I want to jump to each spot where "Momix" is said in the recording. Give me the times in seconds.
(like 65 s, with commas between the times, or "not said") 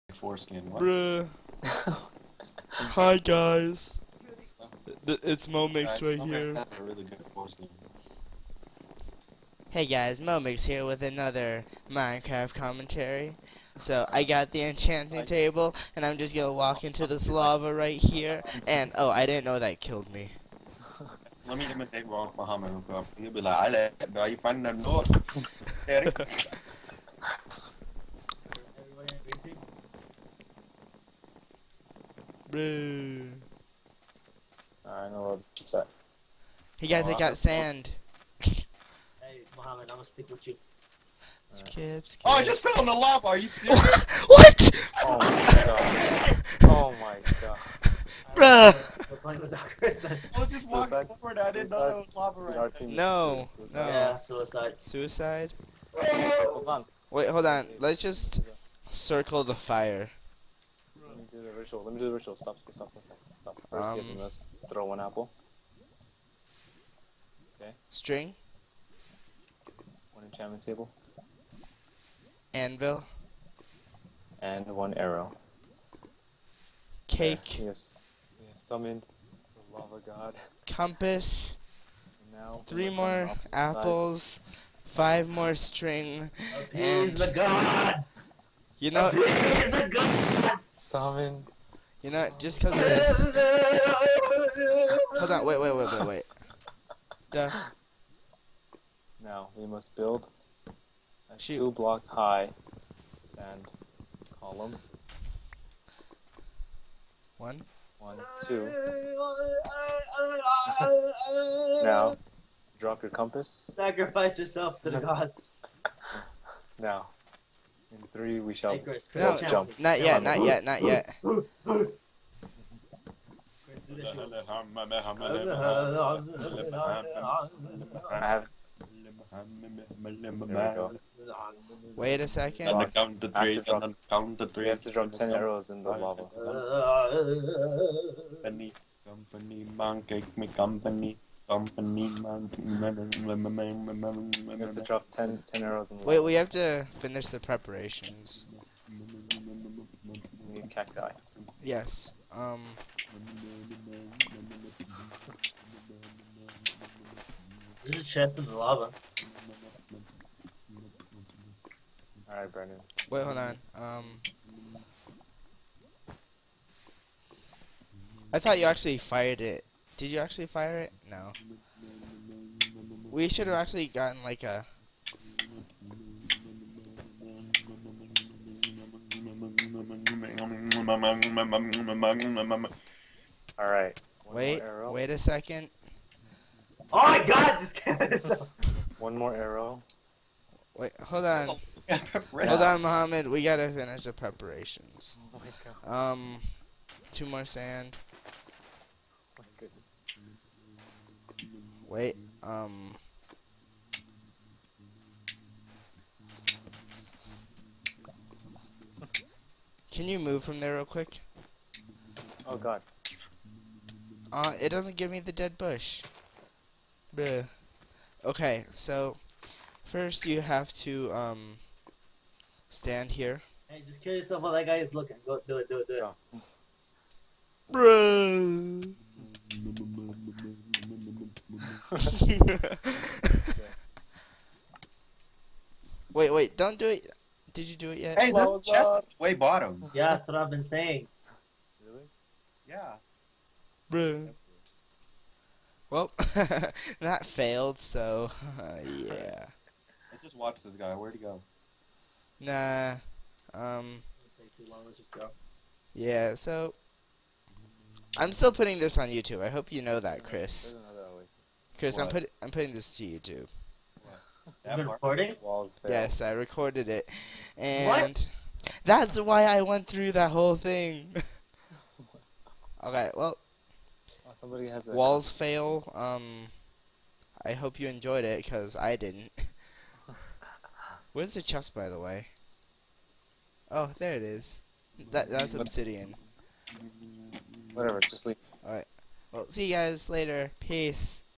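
5 s, 10 s.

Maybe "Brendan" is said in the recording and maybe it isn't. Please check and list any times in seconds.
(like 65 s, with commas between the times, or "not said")
162 s.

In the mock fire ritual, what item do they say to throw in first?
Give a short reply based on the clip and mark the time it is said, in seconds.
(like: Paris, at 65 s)
One apple, at 64 s.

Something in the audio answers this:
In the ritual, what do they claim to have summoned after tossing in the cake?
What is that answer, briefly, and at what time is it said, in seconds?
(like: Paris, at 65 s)
The lava god, at 79 s.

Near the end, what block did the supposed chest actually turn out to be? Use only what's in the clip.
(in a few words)
Obsidian.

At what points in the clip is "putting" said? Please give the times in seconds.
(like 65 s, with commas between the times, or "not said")
258 s, 262 s.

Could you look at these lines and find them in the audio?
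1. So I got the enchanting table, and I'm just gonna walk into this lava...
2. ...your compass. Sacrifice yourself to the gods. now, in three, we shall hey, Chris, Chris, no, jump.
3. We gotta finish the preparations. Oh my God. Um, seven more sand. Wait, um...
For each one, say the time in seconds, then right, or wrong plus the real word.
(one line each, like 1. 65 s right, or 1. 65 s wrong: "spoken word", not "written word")
1. 13 s right
2. 113 s right
3. 193 s wrong: "two", not "seven".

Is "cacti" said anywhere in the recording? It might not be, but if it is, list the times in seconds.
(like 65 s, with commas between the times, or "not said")
150 s.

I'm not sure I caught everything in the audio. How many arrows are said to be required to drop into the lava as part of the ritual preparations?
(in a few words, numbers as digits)
10.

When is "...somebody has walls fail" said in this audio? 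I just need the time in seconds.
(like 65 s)
274 s.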